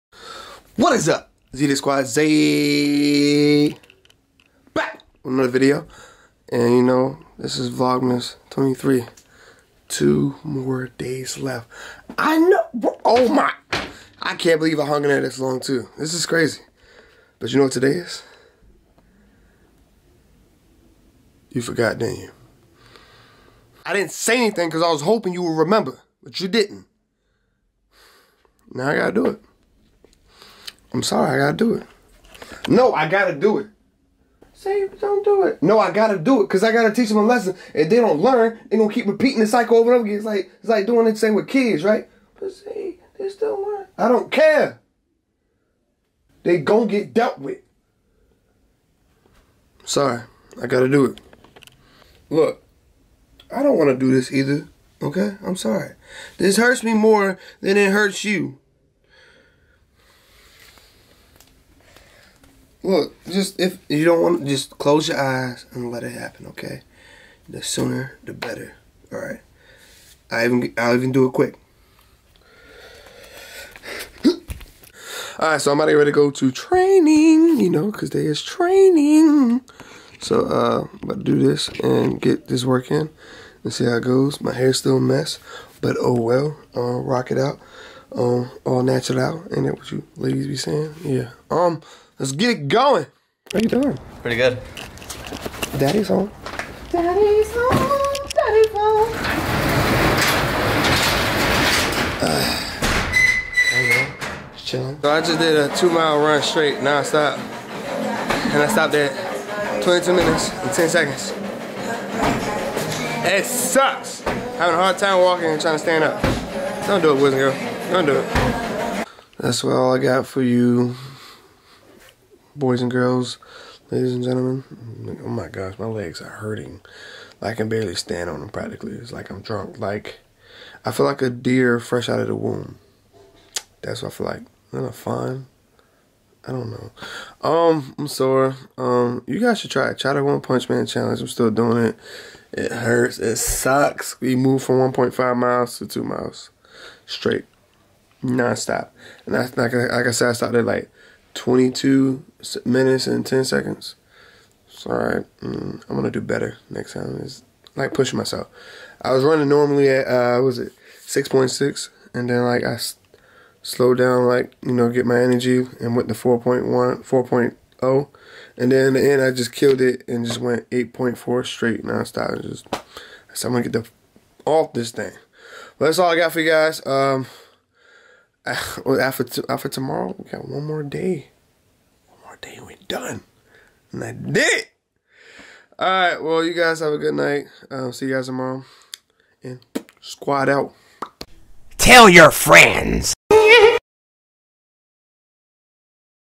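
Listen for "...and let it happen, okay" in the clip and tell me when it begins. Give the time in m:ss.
1:05.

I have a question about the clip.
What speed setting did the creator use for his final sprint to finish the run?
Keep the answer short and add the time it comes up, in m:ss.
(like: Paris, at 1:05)
8.4, at 2:50.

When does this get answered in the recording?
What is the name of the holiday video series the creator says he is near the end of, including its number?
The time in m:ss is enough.
0:07.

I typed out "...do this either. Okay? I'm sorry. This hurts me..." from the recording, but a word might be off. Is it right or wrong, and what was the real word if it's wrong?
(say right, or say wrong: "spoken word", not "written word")
right.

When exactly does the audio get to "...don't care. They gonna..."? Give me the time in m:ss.
0:44.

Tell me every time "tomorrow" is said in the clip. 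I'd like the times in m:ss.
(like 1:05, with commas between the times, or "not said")
2:59, 3:08.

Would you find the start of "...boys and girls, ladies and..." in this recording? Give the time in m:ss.
2:02.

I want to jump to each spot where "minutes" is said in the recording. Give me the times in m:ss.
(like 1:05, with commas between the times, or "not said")
1:50, 2:32.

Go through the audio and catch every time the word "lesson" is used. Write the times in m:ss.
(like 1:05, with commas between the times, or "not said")
0:37.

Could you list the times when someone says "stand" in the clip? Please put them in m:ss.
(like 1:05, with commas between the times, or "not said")
1:55, 2:07.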